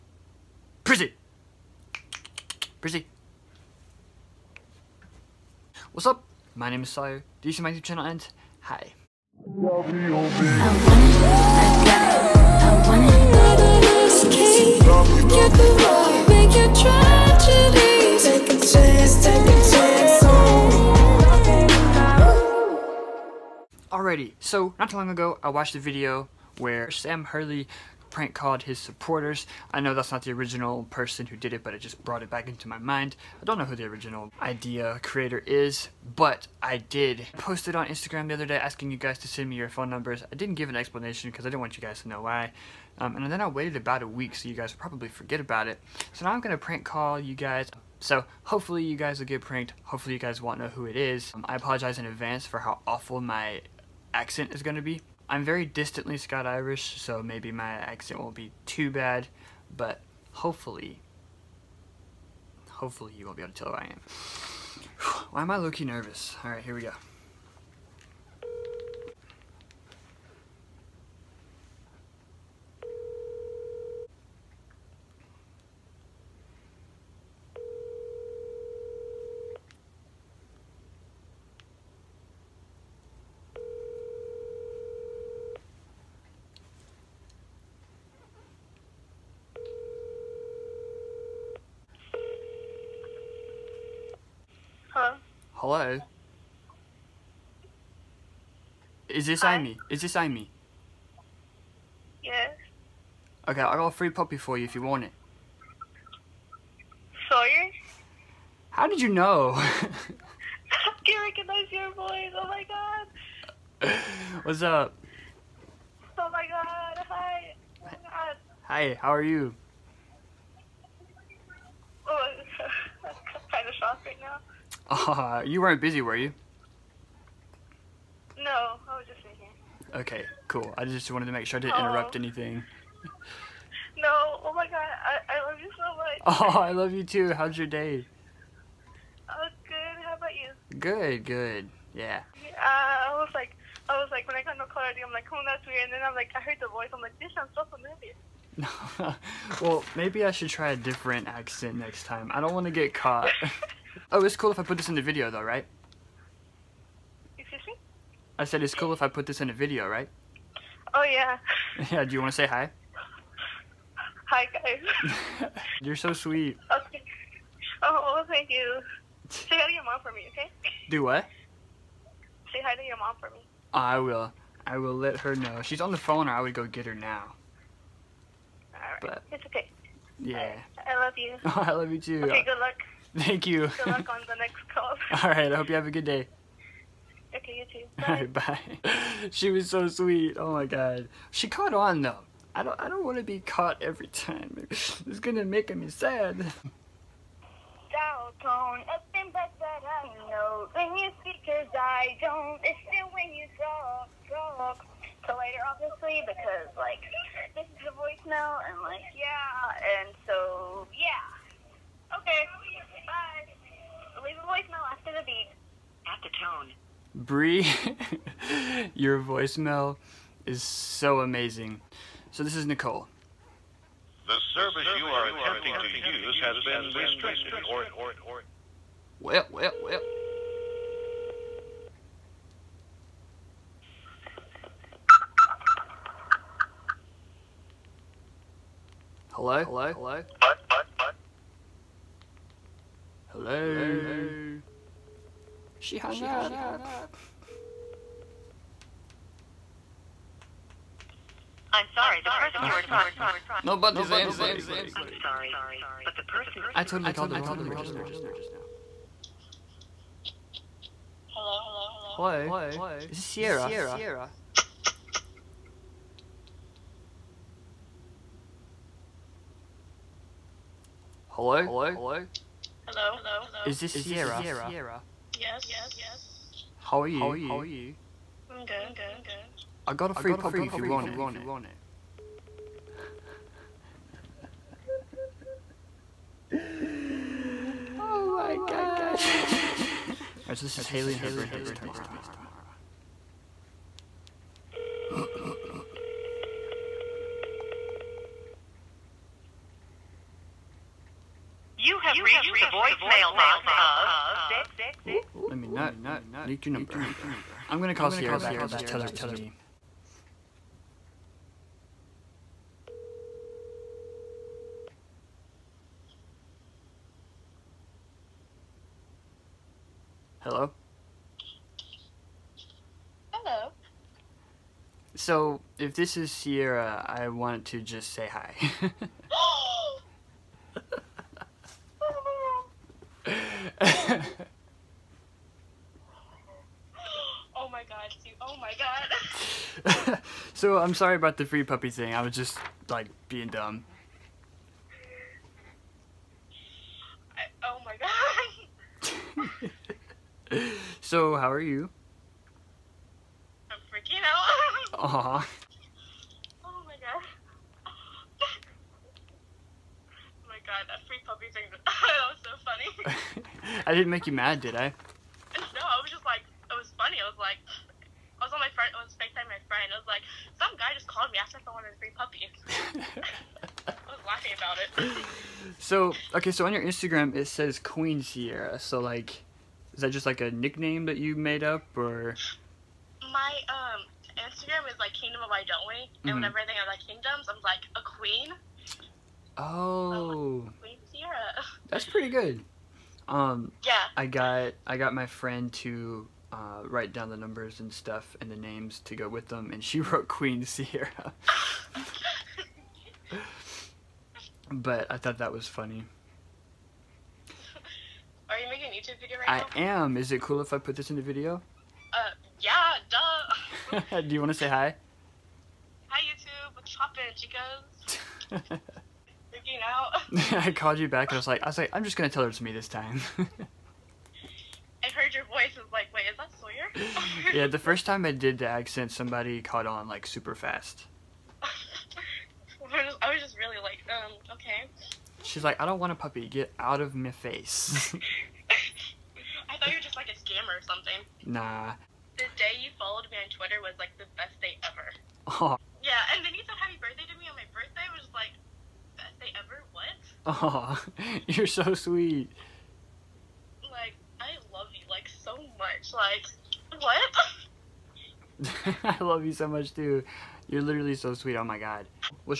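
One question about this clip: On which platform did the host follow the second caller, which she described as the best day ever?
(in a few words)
Twitter.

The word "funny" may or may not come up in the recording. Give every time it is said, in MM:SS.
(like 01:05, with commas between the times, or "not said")
06:02, 06:45.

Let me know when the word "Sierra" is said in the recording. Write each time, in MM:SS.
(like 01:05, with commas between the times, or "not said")
04:23, 04:33, 05:08, 05:26, 06:18, 06:31, 06:40.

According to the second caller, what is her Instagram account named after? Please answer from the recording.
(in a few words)
Kingdom of Why Don't We.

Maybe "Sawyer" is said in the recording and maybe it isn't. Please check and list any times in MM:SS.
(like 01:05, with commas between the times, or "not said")
00:06, 07:06.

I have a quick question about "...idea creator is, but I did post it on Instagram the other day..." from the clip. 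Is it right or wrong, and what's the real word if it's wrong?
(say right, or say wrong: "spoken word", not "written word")
right.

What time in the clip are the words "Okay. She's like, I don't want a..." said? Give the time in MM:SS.
07:14.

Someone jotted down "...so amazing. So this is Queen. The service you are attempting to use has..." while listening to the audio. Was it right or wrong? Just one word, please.
wrong.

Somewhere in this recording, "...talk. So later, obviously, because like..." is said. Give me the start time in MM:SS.
03:24.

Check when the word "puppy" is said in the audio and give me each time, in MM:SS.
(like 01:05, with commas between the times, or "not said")
01:44, 04:40, 05:41, 06:01, 07:16.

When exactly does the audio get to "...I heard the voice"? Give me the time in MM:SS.
02:26.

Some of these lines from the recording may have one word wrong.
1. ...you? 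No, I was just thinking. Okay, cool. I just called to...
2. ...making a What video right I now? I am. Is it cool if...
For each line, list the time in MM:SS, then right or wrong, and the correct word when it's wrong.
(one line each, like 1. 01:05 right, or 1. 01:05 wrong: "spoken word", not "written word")
1. 02:06 wrong: "wanted", not "called"
2. 06:48 wrong: "YouTube", not "What".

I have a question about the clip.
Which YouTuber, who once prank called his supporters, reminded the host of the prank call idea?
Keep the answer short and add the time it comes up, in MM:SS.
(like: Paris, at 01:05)
Sam Hurley, at 00:26.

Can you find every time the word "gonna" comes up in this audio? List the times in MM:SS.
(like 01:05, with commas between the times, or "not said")
03:15, 05:07, 07:02.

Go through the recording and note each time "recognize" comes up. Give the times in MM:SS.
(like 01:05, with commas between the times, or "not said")
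01:51.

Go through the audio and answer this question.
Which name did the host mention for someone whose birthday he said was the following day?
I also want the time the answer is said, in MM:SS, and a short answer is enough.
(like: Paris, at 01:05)
Haley, at 04:50.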